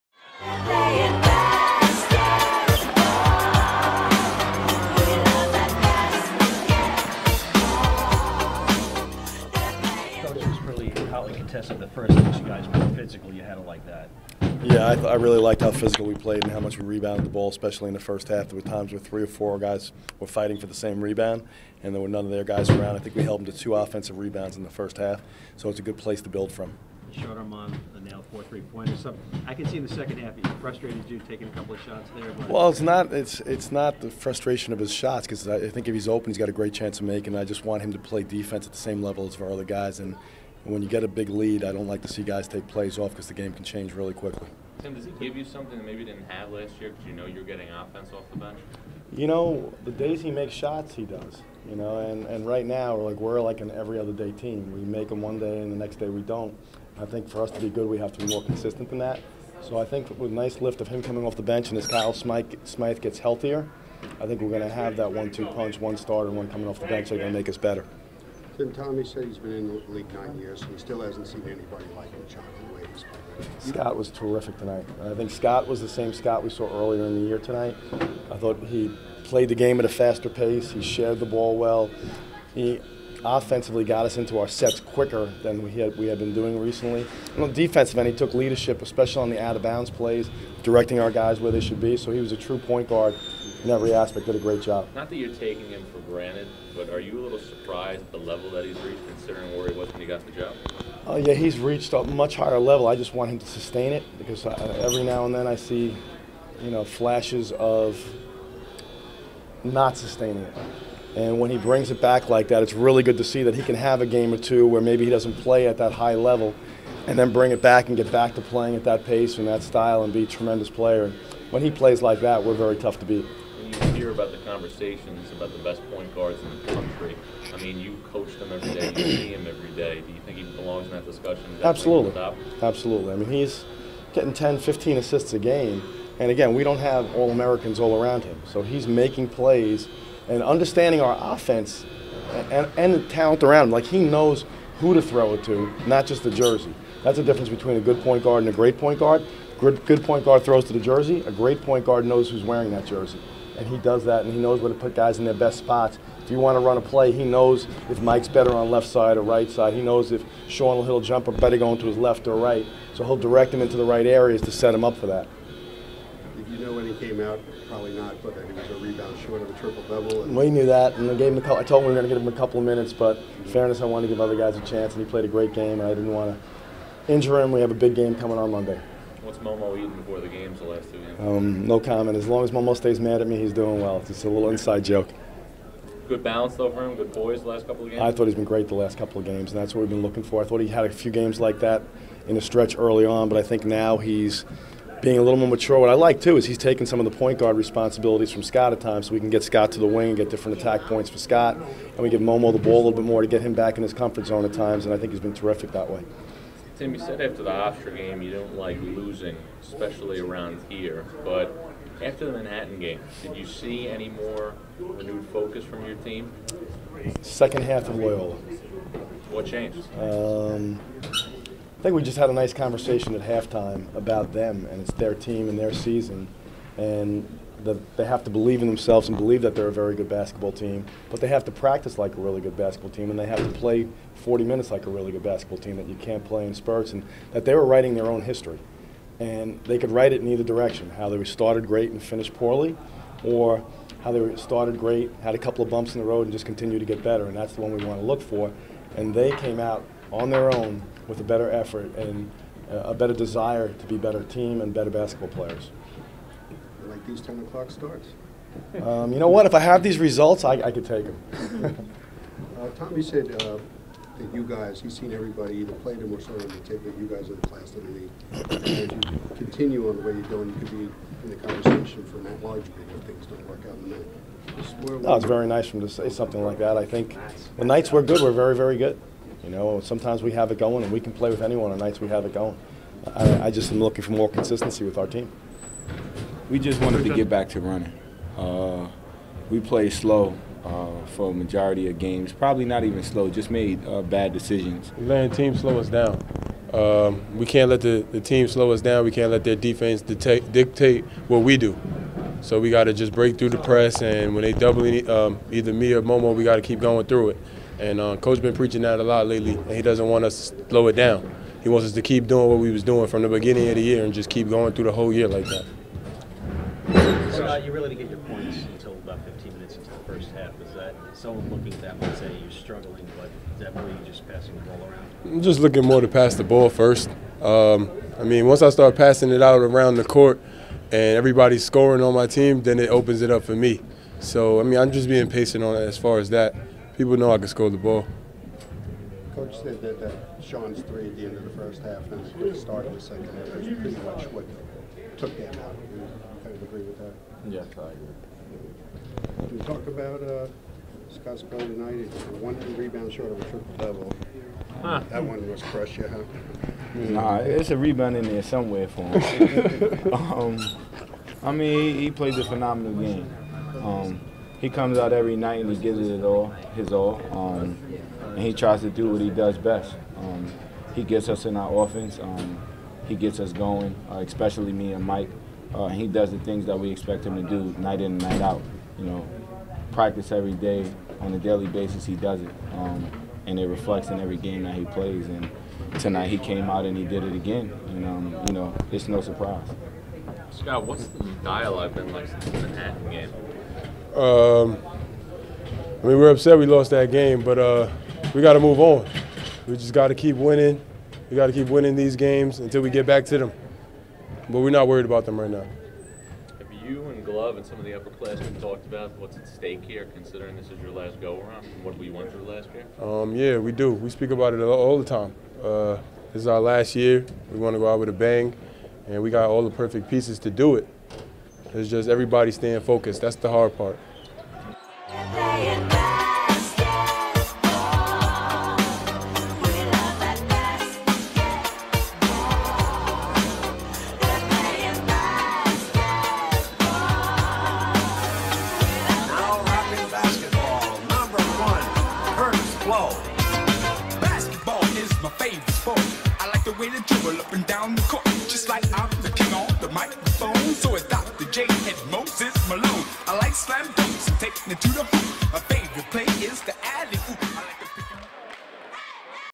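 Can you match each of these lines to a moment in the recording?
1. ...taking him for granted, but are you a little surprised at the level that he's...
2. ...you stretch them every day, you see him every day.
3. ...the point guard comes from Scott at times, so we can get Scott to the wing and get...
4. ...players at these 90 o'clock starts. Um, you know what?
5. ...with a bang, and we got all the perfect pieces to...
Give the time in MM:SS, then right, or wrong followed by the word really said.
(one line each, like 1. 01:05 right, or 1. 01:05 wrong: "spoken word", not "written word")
1. 01:35 right
2. 02:07 wrong: "coach", not "stretch"
3. 03:17 wrong: "responsibilities", not "comes"
4. 04:15 wrong: "10", not "90"
5. 06:57 right.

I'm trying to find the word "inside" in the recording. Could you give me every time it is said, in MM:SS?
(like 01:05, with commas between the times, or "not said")
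03:04.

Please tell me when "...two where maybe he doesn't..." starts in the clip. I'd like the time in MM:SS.
01:54.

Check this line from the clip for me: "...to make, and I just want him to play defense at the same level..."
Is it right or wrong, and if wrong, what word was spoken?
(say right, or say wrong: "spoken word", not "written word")
right.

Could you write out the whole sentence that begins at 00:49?
You know, the days he makes shots, he does.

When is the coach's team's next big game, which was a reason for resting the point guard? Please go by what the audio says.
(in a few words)
Monday.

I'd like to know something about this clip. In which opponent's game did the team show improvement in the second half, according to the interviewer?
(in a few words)
Loyola.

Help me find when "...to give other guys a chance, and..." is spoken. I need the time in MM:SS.
02:54.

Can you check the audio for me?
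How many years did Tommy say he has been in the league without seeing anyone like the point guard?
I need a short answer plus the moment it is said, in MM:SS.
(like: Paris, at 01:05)
9, at 01:10.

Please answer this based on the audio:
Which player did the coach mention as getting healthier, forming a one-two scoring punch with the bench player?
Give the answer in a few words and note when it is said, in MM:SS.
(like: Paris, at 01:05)
Kyle Smyth, at 01:01.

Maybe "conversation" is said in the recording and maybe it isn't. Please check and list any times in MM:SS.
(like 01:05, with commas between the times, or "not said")
02:04, 03:42, 04:31.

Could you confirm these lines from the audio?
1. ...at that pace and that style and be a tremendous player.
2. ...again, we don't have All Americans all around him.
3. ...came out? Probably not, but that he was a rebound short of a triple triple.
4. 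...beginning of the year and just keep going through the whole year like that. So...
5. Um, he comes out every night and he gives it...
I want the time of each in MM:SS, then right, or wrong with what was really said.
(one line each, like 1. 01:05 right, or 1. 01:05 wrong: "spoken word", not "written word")
1. 01:58 right
2. 02:16 right
3. 02:46 wrong: "double", not "triple"
4. 05:13 right
5. 06:03 right.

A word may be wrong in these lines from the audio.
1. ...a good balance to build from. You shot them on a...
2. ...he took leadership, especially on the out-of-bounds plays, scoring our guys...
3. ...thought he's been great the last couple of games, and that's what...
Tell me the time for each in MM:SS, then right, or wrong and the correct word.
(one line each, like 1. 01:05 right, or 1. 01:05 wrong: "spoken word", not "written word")
1. 00:25 wrong: "place", not "balance"
2. 01:28 wrong: "directing", not "scoring"
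3. 03:08 right.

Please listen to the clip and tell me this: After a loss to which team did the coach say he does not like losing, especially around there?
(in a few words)
Hofstra.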